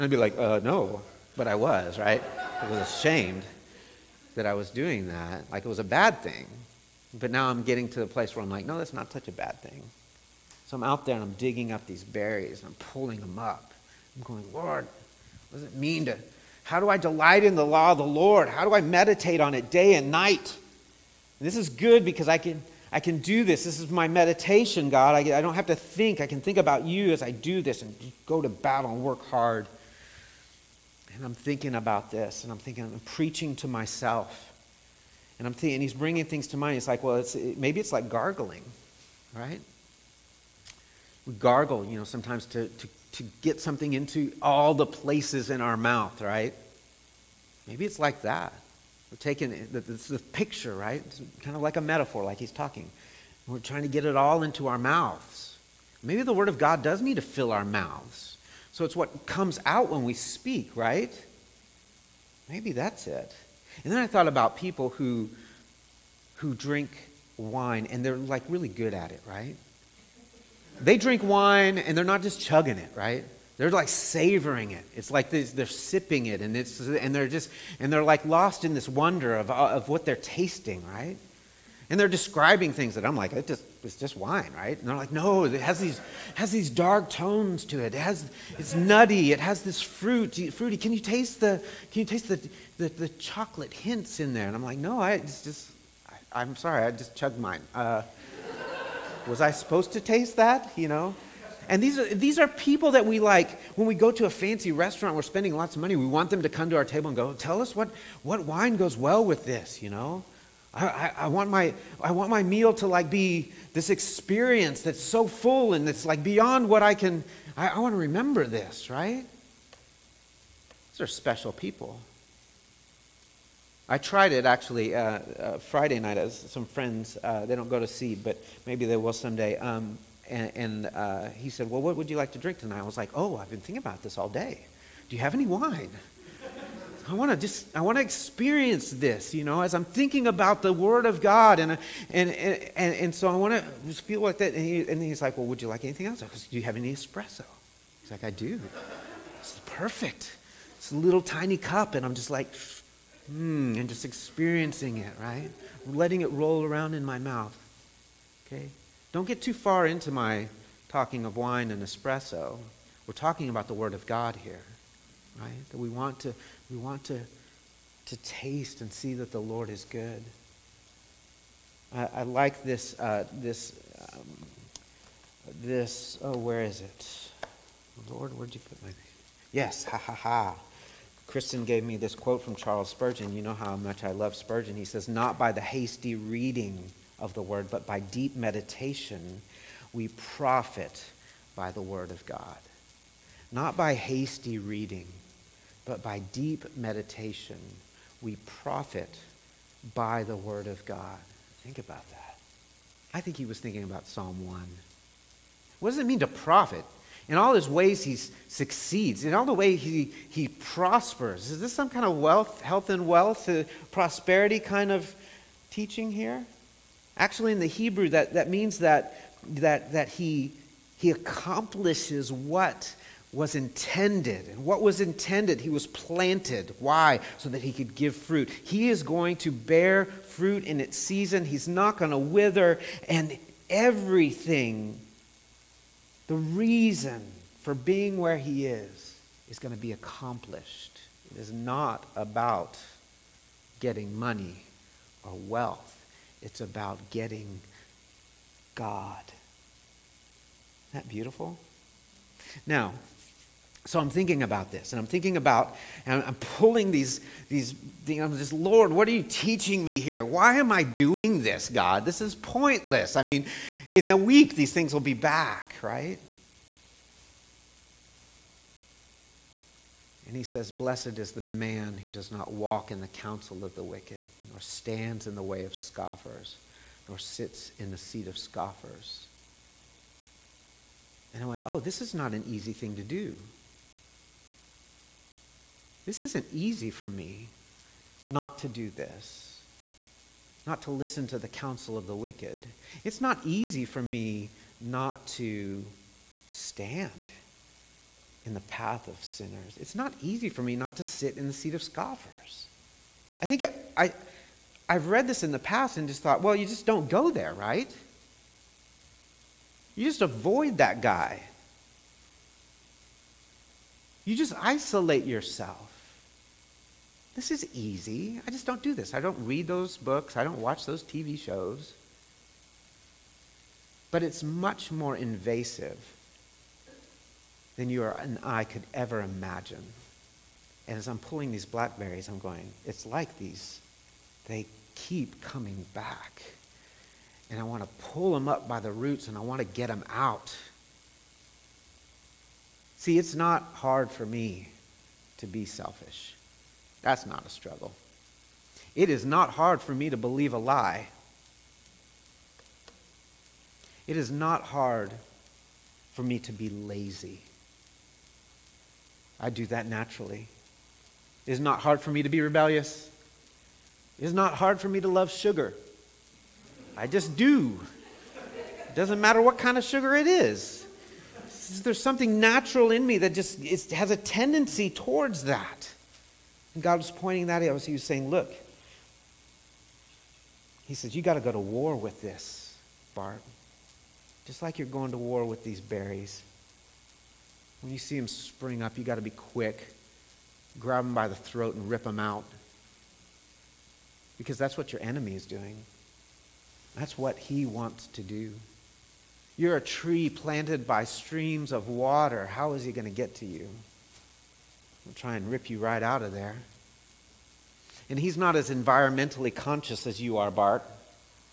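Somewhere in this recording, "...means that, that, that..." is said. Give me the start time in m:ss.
3:38.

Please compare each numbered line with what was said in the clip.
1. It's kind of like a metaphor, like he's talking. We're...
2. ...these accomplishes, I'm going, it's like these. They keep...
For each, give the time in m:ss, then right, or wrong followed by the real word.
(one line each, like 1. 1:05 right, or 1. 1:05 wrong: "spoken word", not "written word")
1. 0:51 right
2. 5:31 wrong: "blackberries", not "accomplishes".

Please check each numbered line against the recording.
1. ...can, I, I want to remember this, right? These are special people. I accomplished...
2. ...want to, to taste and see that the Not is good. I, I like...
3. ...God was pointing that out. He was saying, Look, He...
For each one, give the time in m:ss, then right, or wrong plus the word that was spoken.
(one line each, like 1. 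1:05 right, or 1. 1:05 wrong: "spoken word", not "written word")
1. 1:56 wrong: "tried", not "accomplished"
2. 2:46 wrong: "Lord", not "Not"
3. 6:16 right.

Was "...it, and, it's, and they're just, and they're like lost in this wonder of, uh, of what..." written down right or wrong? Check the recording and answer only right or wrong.
right.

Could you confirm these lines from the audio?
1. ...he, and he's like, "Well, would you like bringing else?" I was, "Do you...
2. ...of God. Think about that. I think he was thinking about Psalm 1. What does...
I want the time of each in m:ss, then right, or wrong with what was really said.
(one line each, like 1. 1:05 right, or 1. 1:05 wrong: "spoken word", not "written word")
1. 2:24 wrong: "anything", not "bringing"
2. 3:20 right.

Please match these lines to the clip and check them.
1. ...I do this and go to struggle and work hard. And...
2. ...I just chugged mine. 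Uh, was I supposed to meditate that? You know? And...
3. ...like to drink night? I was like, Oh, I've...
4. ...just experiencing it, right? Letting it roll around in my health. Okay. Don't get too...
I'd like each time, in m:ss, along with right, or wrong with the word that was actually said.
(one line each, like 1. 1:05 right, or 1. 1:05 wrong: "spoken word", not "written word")
1. 0:27 wrong: "battle", not "struggle"
2. 1:36 wrong: "taste", not "meditate"
3. 2:12 wrong: "tonight", not "night"
4. 2:33 wrong: "mouth", not "health".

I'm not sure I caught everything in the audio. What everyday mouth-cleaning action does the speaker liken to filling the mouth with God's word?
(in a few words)
gargling.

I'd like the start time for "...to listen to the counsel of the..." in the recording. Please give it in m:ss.
4:50.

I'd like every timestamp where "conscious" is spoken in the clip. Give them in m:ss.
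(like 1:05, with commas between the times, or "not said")
6:49.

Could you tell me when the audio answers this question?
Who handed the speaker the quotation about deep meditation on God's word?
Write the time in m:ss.
3:01.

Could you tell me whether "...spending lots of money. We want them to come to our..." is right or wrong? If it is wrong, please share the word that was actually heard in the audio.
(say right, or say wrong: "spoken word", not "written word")
right.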